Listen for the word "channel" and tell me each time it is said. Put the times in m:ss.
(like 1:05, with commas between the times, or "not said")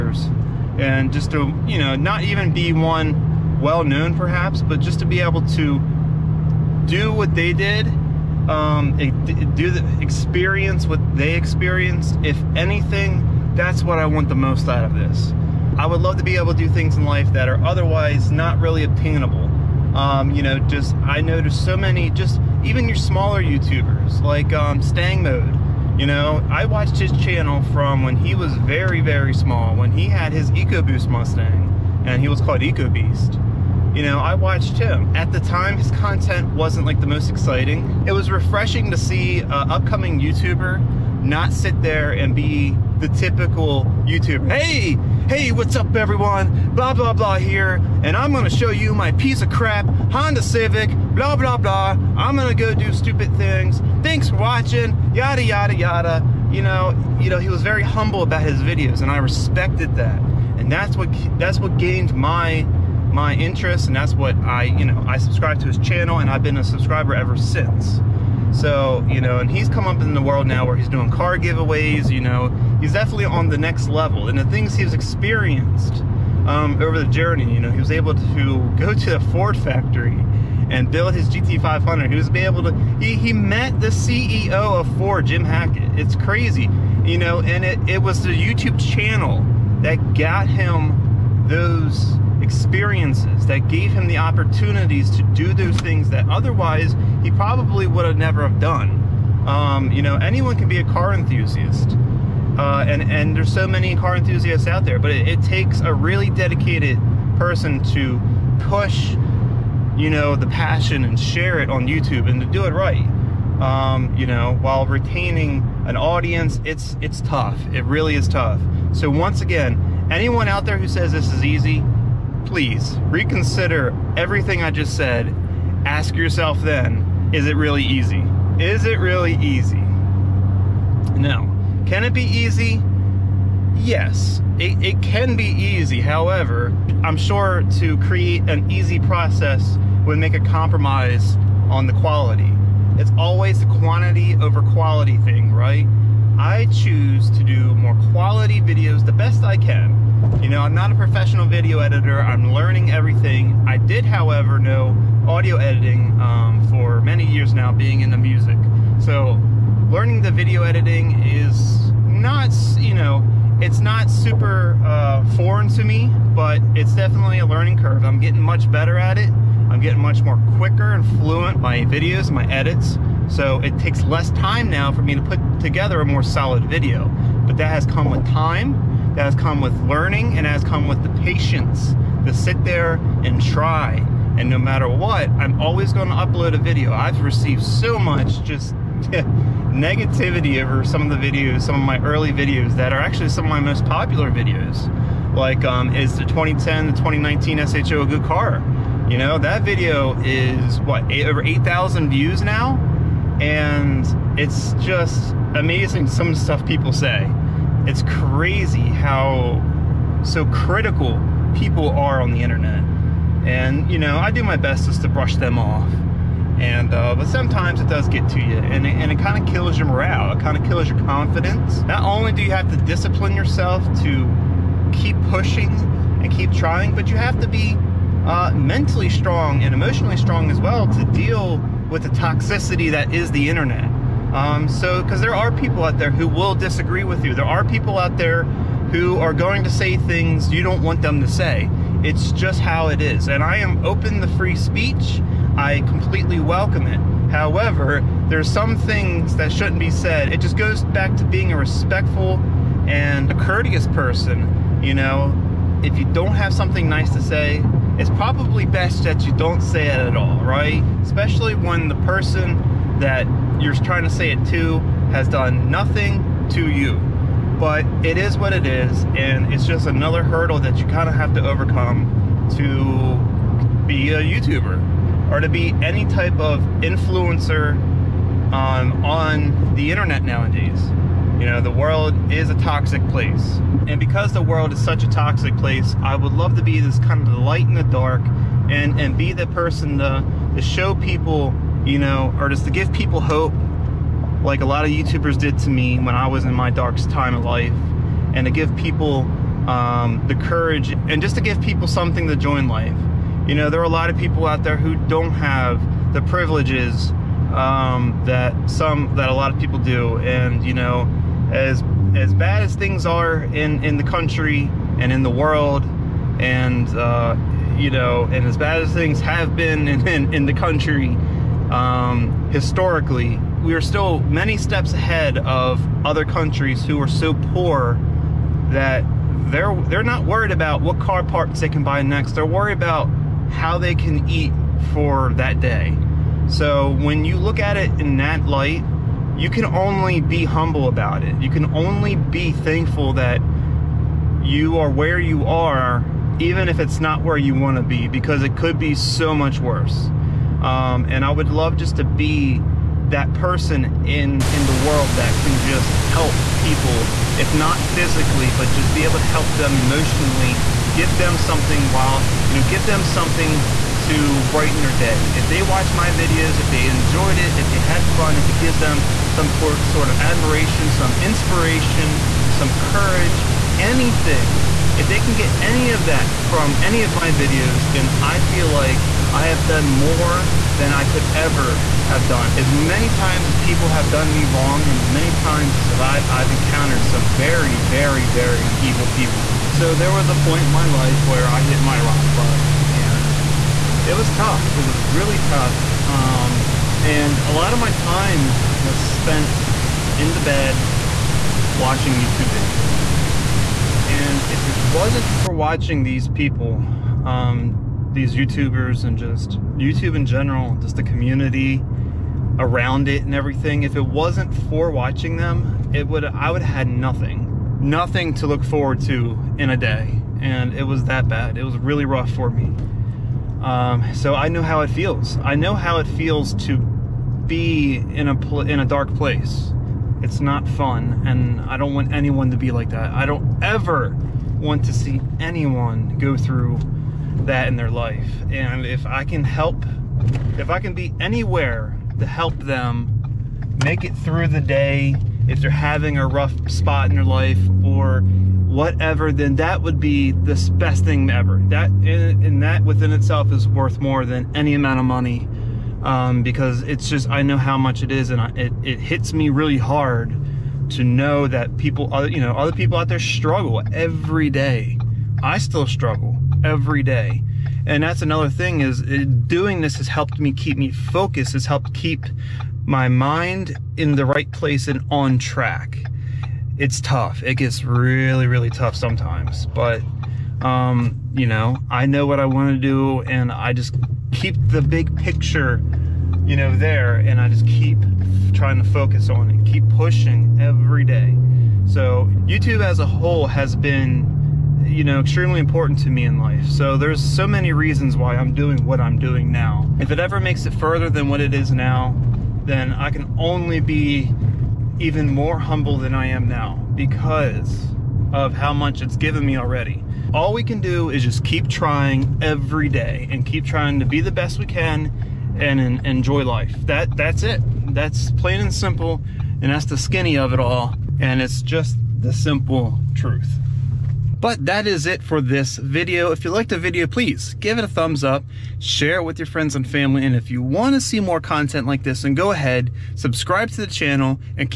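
0:27, 1:05, 1:28, 8:53.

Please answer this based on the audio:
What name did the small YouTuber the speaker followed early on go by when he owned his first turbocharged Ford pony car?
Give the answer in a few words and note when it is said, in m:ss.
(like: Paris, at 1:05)
EcoBeast, at 0:32.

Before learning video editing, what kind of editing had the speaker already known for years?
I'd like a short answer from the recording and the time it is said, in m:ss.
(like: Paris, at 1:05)
Audio editing, at 2:35.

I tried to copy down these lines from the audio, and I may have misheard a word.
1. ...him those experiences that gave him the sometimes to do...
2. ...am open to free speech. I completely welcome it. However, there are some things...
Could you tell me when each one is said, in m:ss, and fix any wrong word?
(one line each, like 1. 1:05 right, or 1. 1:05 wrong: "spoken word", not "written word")
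1. 1:30 wrong: "opportunities", not "sometimes"
2. 4:03 right.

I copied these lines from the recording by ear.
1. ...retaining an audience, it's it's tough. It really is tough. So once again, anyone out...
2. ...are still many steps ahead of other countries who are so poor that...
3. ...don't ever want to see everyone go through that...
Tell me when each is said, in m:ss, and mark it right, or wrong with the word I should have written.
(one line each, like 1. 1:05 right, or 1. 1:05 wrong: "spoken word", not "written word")
1. 1:54 right
2. 5:23 right
3. 7:13 wrong: "anyone", not "everyone".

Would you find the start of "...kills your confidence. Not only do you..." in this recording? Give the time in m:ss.
3:40.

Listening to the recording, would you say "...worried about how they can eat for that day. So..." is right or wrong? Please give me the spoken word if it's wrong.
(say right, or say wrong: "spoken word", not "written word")
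right.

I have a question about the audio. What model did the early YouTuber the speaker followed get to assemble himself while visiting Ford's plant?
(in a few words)
GT500.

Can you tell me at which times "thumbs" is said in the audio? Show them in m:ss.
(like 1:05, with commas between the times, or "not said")
8:47.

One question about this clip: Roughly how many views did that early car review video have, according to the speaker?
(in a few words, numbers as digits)
Over 8,000.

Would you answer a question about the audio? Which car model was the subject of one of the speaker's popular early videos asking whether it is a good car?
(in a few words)
2019 SHO.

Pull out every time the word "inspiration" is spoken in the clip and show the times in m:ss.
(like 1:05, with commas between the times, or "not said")
6:11.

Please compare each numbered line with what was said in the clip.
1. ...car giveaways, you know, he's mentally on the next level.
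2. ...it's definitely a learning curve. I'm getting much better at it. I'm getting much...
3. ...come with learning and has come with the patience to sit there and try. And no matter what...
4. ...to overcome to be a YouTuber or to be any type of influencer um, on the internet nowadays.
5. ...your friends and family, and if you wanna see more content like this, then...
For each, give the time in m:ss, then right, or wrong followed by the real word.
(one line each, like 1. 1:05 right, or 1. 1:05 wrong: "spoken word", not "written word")
1. 1:11 wrong: "definitely", not "mentally"
2. 2:46 right
3. 2:59 right
4. 4:31 right
5. 8:49 right.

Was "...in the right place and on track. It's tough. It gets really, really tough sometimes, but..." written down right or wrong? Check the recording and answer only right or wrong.
right.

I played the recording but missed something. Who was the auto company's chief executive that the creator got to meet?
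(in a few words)
Jim Hackett.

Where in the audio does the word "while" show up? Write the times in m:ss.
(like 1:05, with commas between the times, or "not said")
1:54, 6:01.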